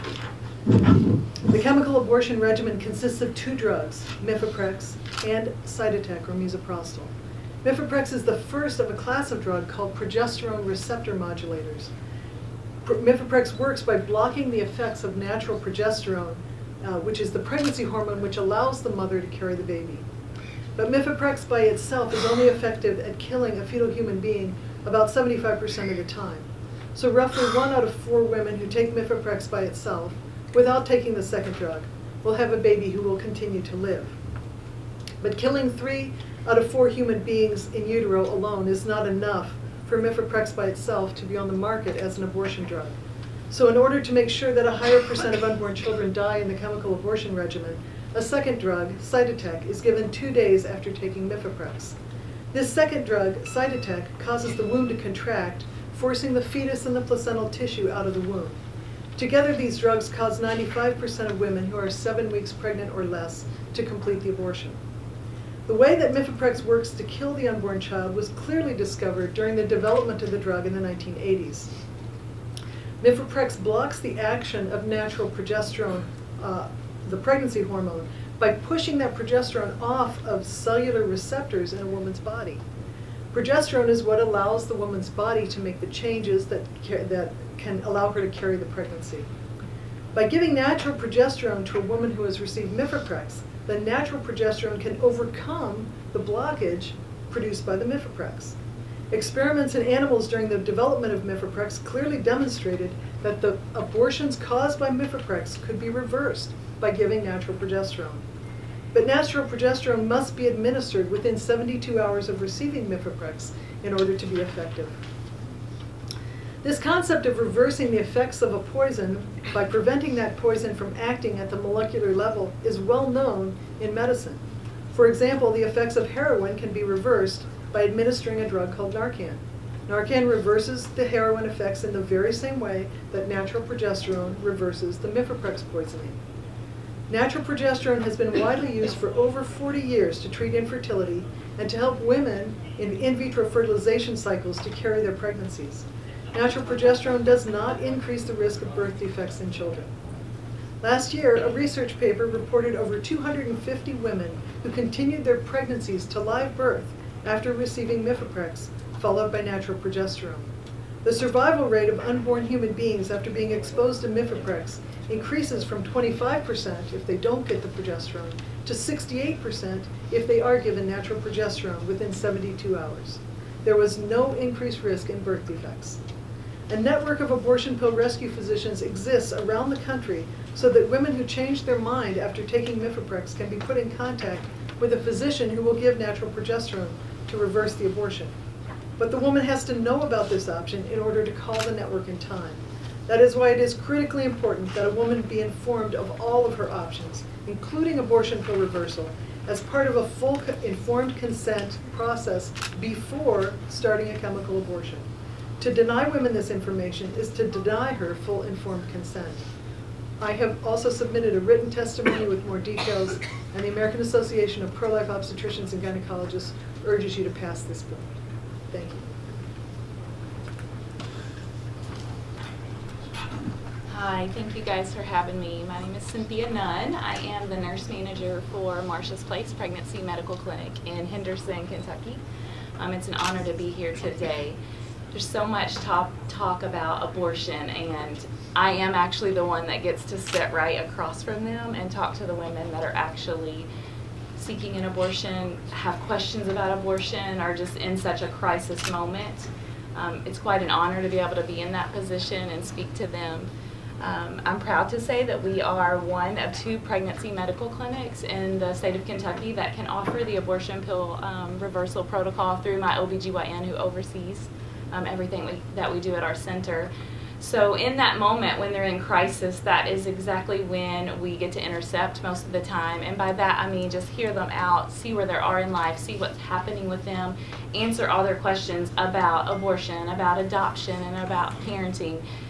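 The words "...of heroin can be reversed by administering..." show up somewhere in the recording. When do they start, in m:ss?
2:05.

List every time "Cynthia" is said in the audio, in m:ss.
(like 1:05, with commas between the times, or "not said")
3:46.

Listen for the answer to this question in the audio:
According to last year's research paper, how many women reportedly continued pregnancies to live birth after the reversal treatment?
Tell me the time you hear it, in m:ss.
2:33.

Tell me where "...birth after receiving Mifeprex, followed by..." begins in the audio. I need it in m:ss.
2:36.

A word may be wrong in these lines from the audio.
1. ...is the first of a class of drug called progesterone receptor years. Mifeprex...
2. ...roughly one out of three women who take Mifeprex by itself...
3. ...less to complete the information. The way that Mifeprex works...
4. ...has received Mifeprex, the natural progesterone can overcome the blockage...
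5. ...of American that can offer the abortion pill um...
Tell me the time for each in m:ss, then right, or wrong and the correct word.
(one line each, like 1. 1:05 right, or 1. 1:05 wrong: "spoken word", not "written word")
1. 0:08 wrong: "modulators", not "years"
2. 0:27 wrong: "four", not "three"
3. 1:03 wrong: "abortion", not "information"
4. 1:32 right
5. 4:18 wrong: "Kentucky", not "American".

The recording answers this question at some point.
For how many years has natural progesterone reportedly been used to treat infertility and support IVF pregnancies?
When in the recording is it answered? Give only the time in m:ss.
2:19.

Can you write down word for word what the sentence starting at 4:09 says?
Um, it's quite an honor to be able to be in that position and speak to them.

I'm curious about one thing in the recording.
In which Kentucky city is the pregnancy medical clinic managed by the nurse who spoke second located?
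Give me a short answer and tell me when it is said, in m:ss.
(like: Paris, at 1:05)
Henderson, at 3:51.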